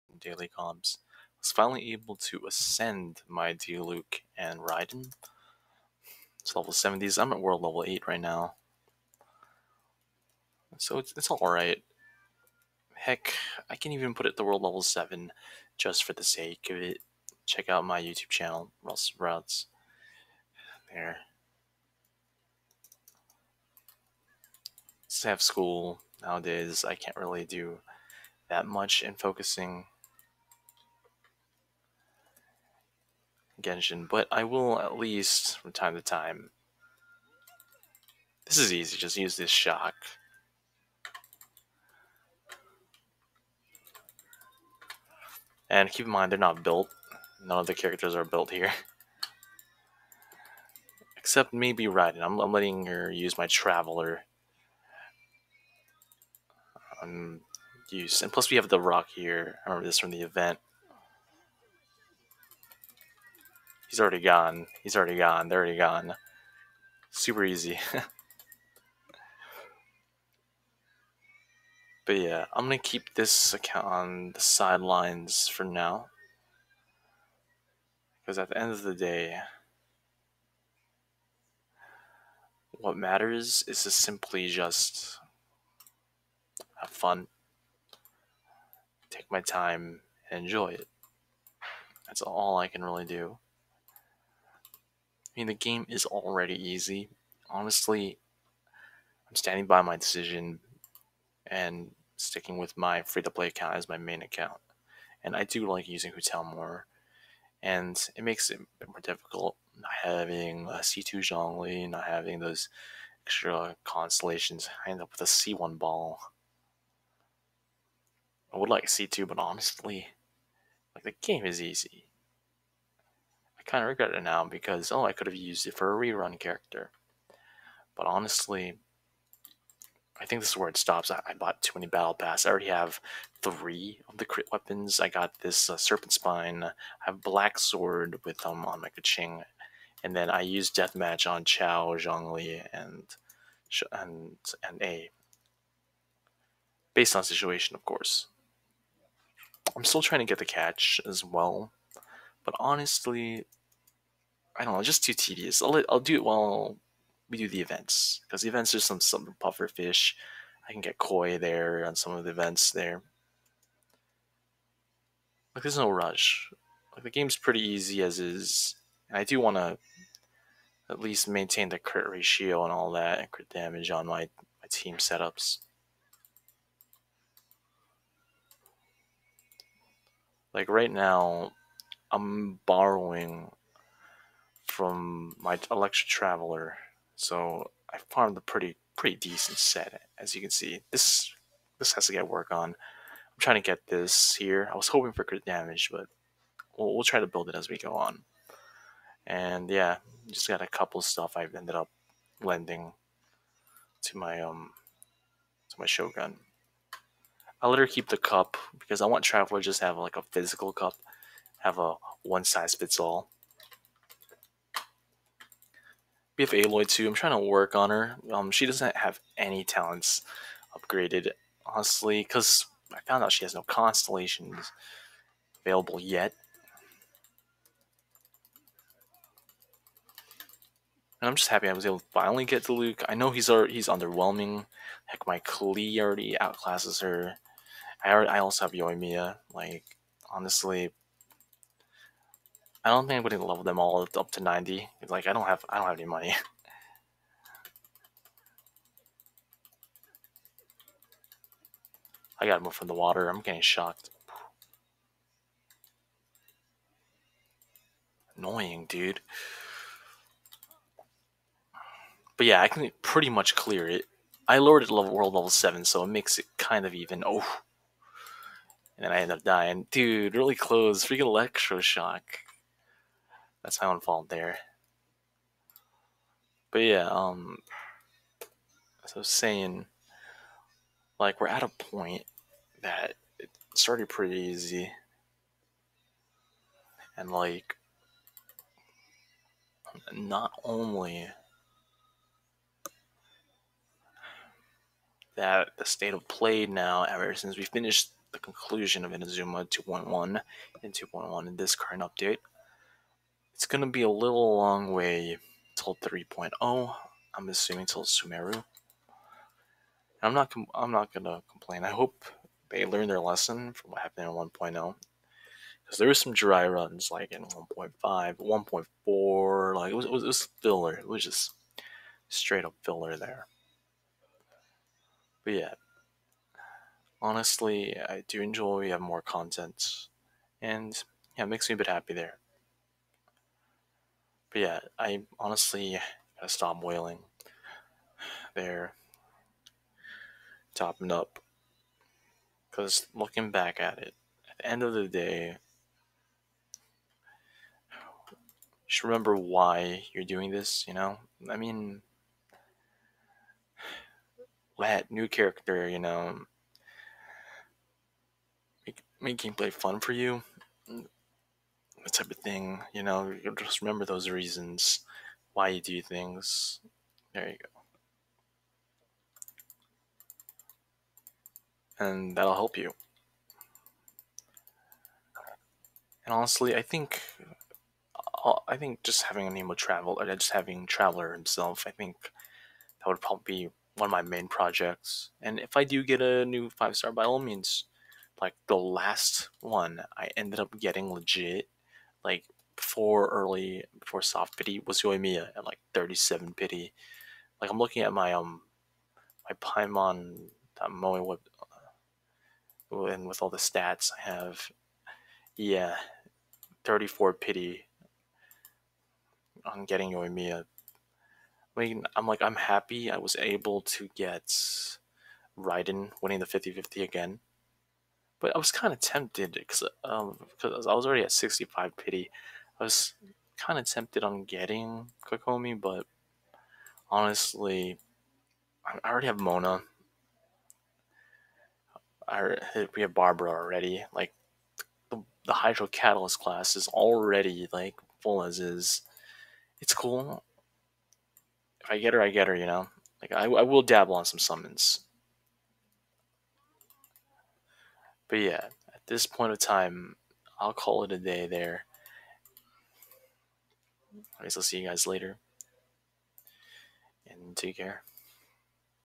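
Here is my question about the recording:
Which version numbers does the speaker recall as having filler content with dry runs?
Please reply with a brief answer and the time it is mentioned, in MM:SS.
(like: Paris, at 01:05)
1.5 and 1.4, at 05:17.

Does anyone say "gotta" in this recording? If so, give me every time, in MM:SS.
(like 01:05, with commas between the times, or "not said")
04:12, 05:36.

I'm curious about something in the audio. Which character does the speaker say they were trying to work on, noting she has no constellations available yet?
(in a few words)
Aloy.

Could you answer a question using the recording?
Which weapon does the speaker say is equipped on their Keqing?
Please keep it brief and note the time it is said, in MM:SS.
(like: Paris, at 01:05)
Black sword, at 02:17.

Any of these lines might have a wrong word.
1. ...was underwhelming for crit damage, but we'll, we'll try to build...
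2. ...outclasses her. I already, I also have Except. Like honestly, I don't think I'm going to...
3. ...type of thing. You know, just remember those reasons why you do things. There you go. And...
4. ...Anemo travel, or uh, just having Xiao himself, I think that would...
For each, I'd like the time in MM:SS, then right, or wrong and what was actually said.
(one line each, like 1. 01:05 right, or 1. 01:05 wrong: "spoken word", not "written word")
1. 03:14 wrong: "hoping", not "underwhelming"
2. 03:56 wrong: "Yoimiya", not "Except"
3. 06:02 right
4. 06:19 wrong: "Traveler", not "Xiao".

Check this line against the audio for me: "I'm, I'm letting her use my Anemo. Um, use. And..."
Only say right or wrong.
wrong.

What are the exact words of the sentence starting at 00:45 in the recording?
And keep in mind, they're not built.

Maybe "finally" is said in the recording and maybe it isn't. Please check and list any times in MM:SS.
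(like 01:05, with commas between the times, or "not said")
00:01, 03:52.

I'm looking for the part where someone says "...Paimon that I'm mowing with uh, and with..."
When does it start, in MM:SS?
06:39.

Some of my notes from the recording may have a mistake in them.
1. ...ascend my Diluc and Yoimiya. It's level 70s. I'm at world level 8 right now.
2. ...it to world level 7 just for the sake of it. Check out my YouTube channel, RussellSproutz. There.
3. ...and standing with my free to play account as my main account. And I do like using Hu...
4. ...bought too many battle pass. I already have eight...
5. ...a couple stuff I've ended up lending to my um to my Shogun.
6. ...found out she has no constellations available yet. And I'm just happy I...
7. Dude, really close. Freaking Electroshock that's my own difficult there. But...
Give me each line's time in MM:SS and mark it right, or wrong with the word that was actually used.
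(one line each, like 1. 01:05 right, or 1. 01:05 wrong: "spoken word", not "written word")
1. 00:02 wrong: "Raiden", not "Yoimiya"
2. 00:14 right
3. 01:41 wrong: "sticking", not "standing"
4. 02:11 wrong: "three", not "eight"
5. 03:20 right
6. 03:43 right
7. 04:29 wrong: "fault", not "difficult".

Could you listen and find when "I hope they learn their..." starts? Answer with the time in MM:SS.
05:11.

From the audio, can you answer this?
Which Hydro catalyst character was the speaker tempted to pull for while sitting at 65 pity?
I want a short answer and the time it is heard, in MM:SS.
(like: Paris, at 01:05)
Kokomi, at 07:05.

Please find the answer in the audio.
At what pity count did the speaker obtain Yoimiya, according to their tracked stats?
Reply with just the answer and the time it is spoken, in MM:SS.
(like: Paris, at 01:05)
34, at 06:46.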